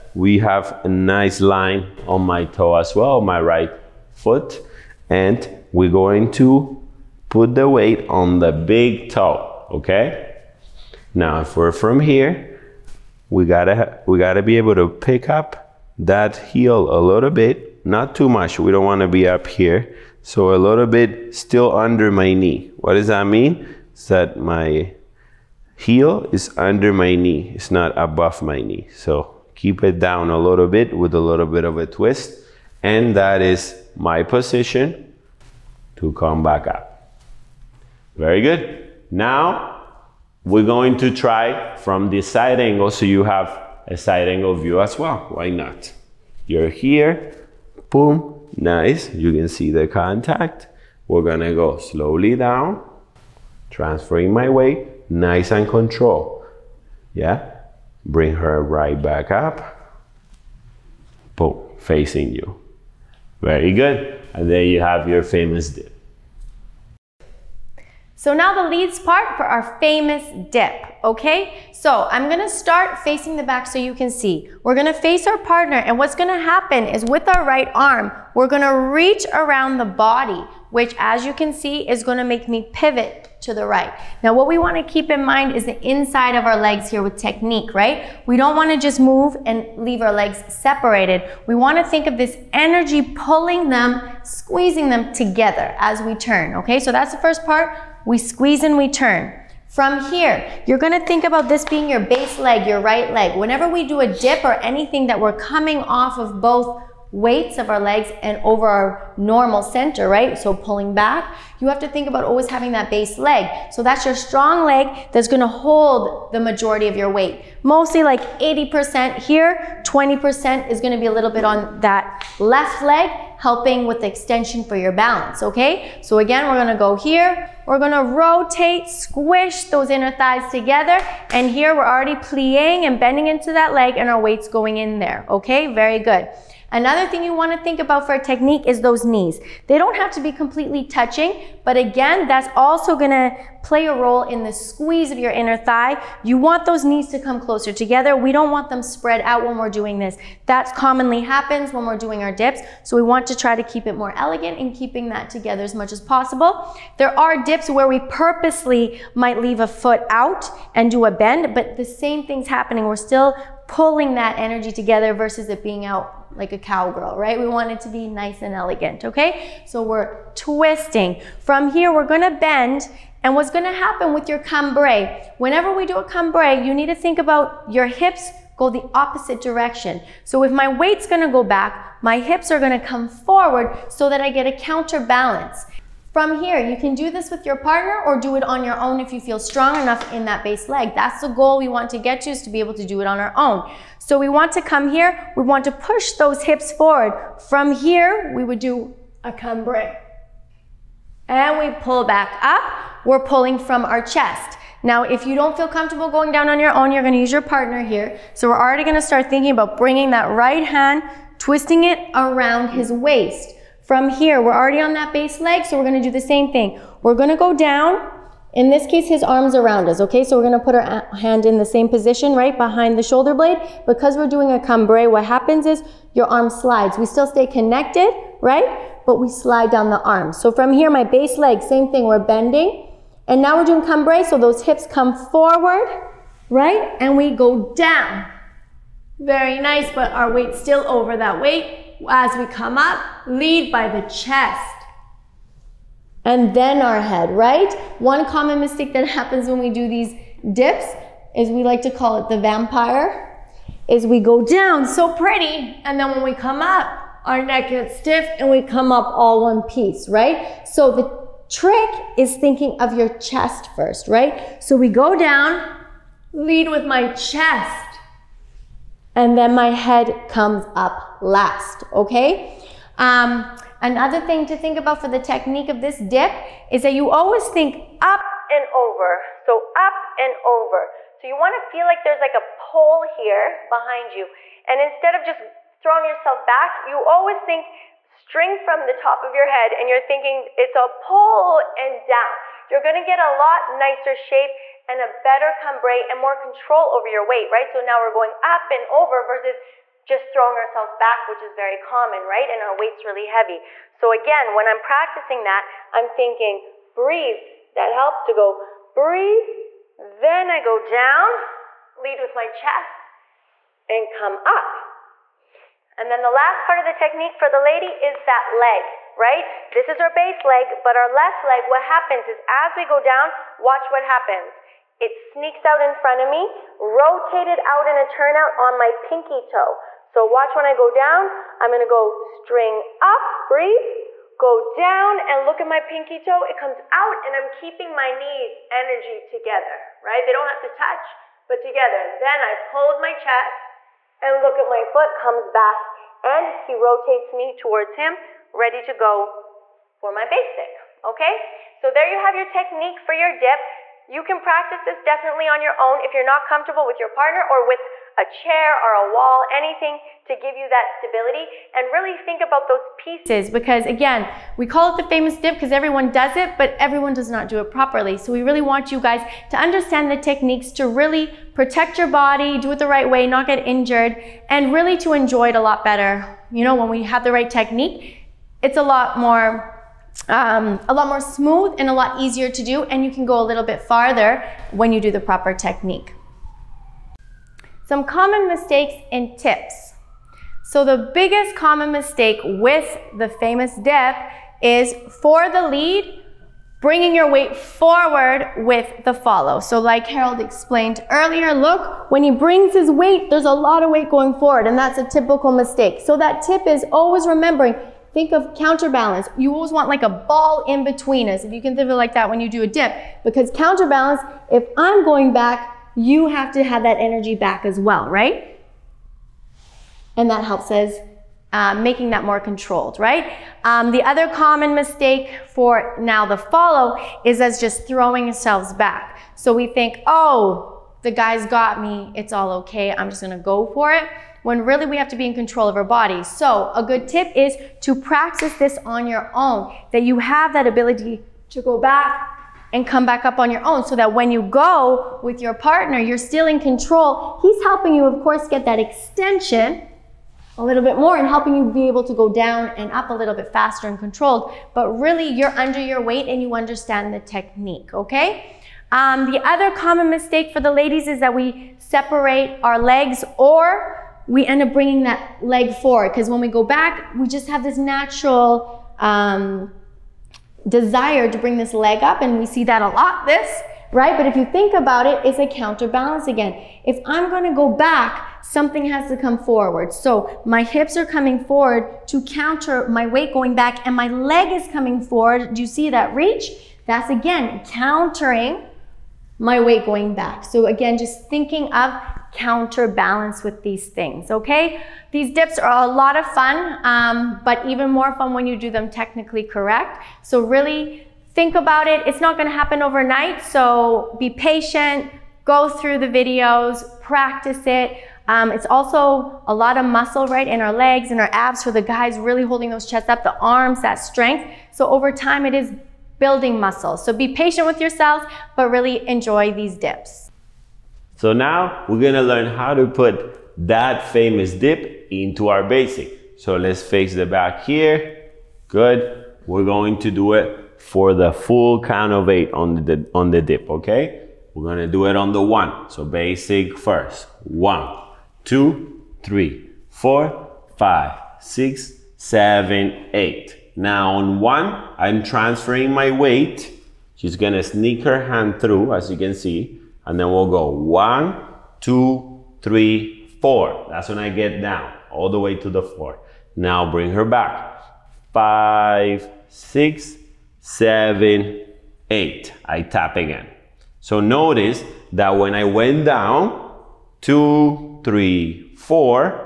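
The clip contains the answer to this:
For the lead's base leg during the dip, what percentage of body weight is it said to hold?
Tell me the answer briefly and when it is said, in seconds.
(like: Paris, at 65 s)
80%, at 118 s.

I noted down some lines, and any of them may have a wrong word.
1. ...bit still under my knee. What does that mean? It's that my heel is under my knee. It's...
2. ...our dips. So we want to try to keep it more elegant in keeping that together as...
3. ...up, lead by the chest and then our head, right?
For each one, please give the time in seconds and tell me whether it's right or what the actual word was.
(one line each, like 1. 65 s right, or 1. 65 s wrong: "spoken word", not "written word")
1. 20 s right
2. 152 s right
3. 242 s right.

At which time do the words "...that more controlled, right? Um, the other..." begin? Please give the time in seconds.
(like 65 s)
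422 s.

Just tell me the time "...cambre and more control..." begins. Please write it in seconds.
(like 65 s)
295 s.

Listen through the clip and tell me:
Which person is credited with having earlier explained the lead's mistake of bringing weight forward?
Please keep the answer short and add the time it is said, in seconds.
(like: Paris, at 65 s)
Harold, at 400 s.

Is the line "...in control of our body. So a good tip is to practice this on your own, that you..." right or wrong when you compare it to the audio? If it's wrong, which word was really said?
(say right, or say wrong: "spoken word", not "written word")
right.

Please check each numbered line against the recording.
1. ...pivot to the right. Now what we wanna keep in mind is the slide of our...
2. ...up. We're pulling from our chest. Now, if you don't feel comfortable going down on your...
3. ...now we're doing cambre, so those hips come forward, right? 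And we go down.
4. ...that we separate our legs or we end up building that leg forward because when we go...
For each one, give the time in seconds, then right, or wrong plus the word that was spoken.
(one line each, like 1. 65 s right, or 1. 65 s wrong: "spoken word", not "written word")
1. 82 s wrong: "inside", not "slide"
2. 202 s right
3. 233 s right
4. 461 s wrong: "bringing", not "building".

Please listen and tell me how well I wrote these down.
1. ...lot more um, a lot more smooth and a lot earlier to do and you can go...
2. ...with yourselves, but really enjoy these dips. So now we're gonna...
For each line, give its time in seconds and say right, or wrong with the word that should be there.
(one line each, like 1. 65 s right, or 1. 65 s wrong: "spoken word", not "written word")
1. 378 s wrong: "easier", not "earlier"
2. 517 s right.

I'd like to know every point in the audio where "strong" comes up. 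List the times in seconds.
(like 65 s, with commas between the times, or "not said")
114 s, 189 s.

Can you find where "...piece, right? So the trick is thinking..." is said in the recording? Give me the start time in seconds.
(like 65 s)
259 s.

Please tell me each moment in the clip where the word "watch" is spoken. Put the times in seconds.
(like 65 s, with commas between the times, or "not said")
323 s, 330 s.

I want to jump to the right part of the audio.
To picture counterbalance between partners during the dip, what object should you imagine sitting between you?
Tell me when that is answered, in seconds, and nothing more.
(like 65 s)
410 s.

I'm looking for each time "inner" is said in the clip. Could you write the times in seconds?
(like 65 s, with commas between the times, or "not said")
129 s, 145 s.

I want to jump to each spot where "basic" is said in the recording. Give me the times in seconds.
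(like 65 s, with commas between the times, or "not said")
350 s, 525 s, 536 s.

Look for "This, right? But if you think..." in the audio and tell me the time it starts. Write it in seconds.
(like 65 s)
473 s.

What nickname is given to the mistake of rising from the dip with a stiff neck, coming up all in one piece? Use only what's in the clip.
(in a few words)
the vampire.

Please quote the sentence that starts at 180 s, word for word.
So if my weight's gonna go back, my hips are gonna come forward so that I get a counterbalance.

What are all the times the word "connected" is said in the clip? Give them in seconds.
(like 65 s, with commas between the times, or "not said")
227 s.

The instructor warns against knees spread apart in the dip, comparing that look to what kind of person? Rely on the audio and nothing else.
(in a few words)
a cowgirl.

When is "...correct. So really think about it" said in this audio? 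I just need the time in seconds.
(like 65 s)
499 s.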